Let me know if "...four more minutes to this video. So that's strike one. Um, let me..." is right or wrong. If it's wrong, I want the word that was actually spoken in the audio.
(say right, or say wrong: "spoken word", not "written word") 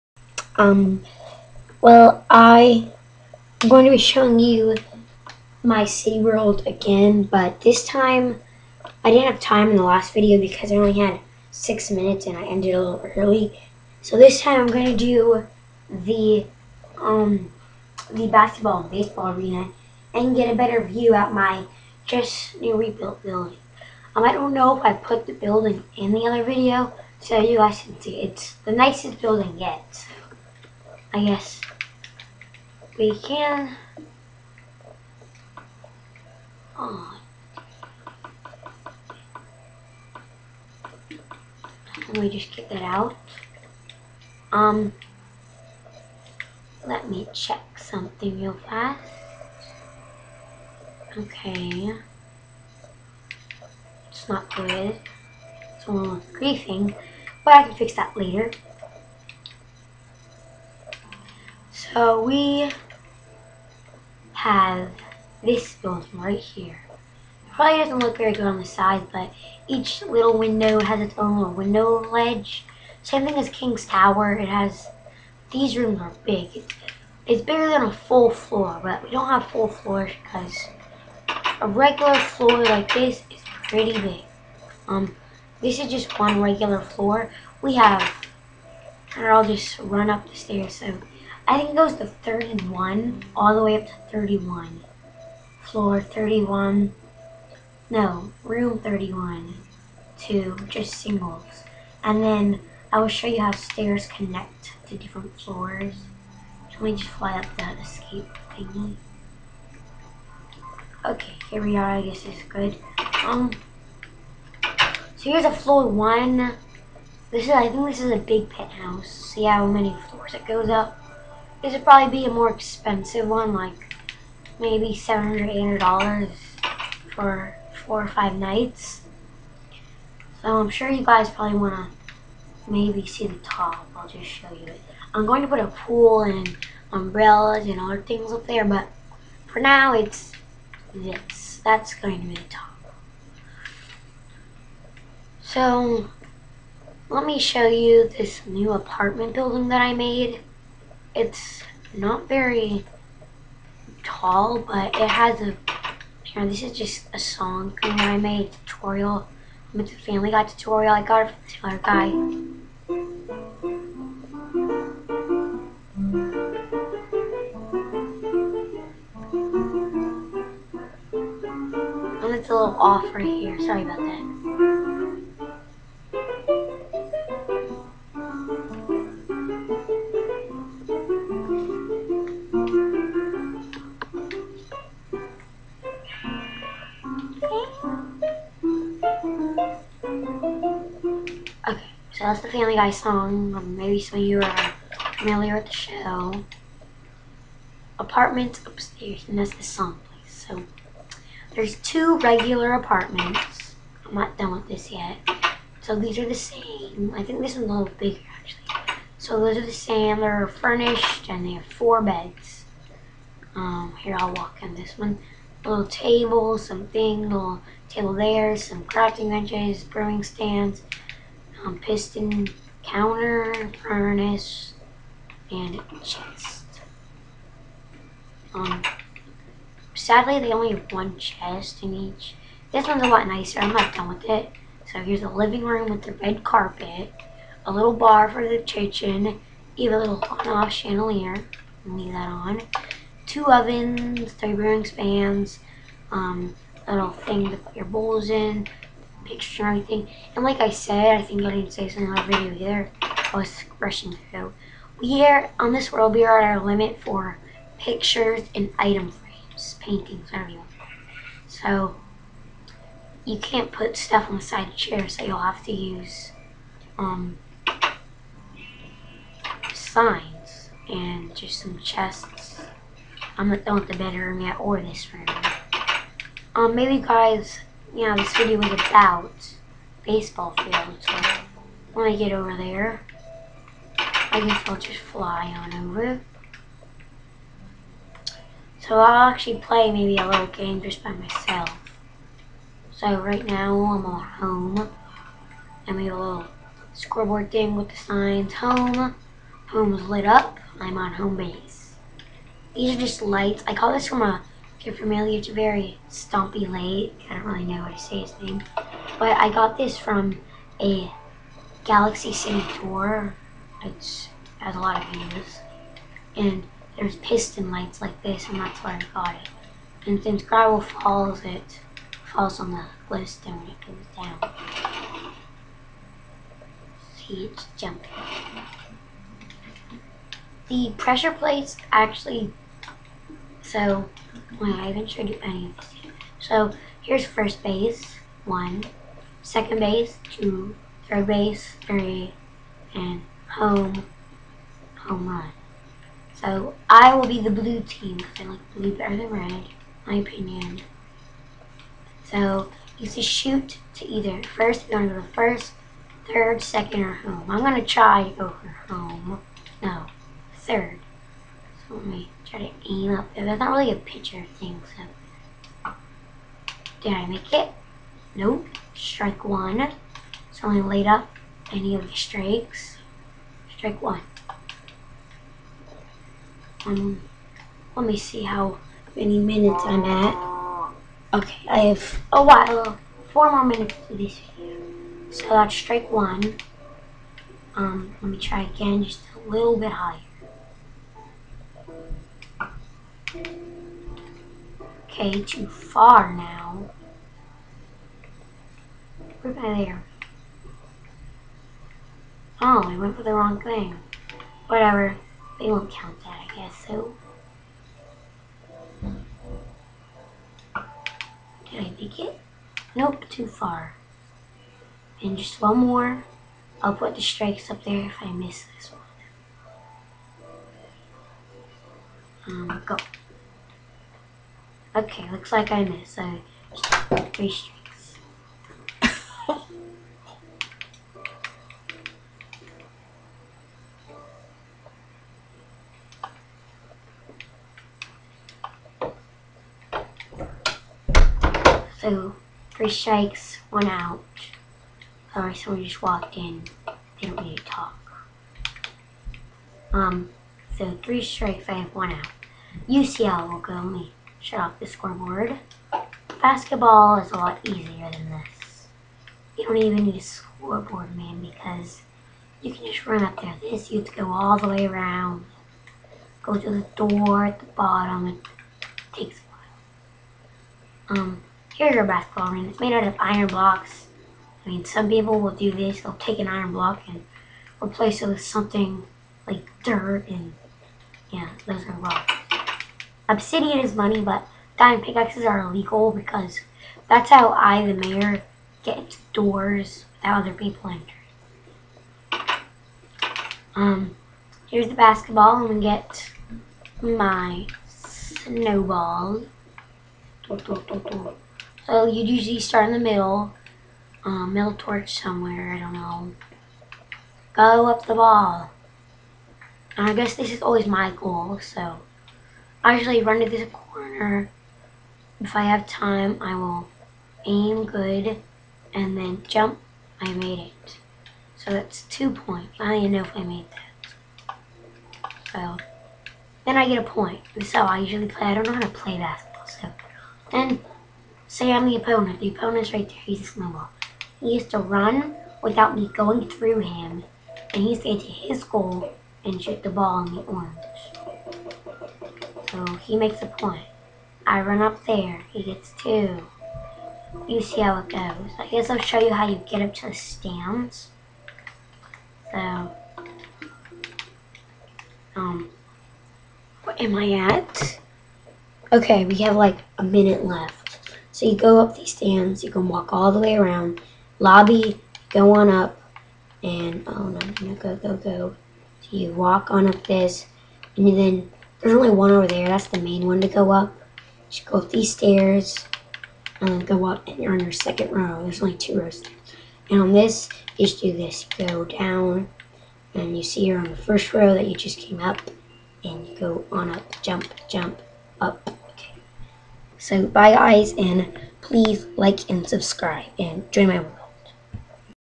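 right.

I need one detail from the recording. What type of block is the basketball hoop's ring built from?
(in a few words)
Iron blocks.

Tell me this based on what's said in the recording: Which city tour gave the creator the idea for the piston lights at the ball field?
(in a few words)
Galaxy City tour.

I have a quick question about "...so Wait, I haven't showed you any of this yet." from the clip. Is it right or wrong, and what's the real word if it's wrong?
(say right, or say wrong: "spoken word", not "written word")
right.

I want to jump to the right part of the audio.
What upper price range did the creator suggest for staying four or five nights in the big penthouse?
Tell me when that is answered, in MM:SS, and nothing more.
02:04.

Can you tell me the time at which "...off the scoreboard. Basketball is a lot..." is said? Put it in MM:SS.
07:34.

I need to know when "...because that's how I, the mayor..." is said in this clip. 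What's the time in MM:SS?
08:06.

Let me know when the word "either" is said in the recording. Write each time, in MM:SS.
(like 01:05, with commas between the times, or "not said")
04:12, 05:54.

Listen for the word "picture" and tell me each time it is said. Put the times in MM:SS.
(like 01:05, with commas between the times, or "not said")
04:09, 04:17, 06:03.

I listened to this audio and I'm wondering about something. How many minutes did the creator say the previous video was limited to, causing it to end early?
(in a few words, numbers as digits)
6.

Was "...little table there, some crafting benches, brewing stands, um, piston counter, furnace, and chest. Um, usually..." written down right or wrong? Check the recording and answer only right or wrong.
wrong.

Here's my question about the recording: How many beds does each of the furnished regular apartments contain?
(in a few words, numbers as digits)
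4.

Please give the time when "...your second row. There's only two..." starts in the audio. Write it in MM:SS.
09:37.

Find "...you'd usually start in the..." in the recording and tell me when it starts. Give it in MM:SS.
08:22.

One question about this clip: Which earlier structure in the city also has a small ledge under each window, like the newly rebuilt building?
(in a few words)
King's Tower.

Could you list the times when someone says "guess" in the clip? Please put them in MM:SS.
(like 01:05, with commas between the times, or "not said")
00:31, 01:52, 04:44, 06:46, 08:30, 09:08.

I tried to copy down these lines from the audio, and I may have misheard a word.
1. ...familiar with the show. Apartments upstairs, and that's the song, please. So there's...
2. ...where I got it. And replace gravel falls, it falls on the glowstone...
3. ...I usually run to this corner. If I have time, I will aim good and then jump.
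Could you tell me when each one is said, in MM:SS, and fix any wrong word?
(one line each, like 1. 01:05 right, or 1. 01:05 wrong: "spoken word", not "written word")
1. 03:15 right
2. 05:18 wrong: "since", not "replace"
3. 08:32 right.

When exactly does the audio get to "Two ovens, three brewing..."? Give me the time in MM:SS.
04:03.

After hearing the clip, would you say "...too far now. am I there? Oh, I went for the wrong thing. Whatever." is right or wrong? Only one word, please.
right.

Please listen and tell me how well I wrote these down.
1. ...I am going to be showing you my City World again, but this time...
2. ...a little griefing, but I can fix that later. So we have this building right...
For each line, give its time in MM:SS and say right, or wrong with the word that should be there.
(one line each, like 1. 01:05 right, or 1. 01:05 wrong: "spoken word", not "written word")
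1. 00:02 right
2. 00:55 right.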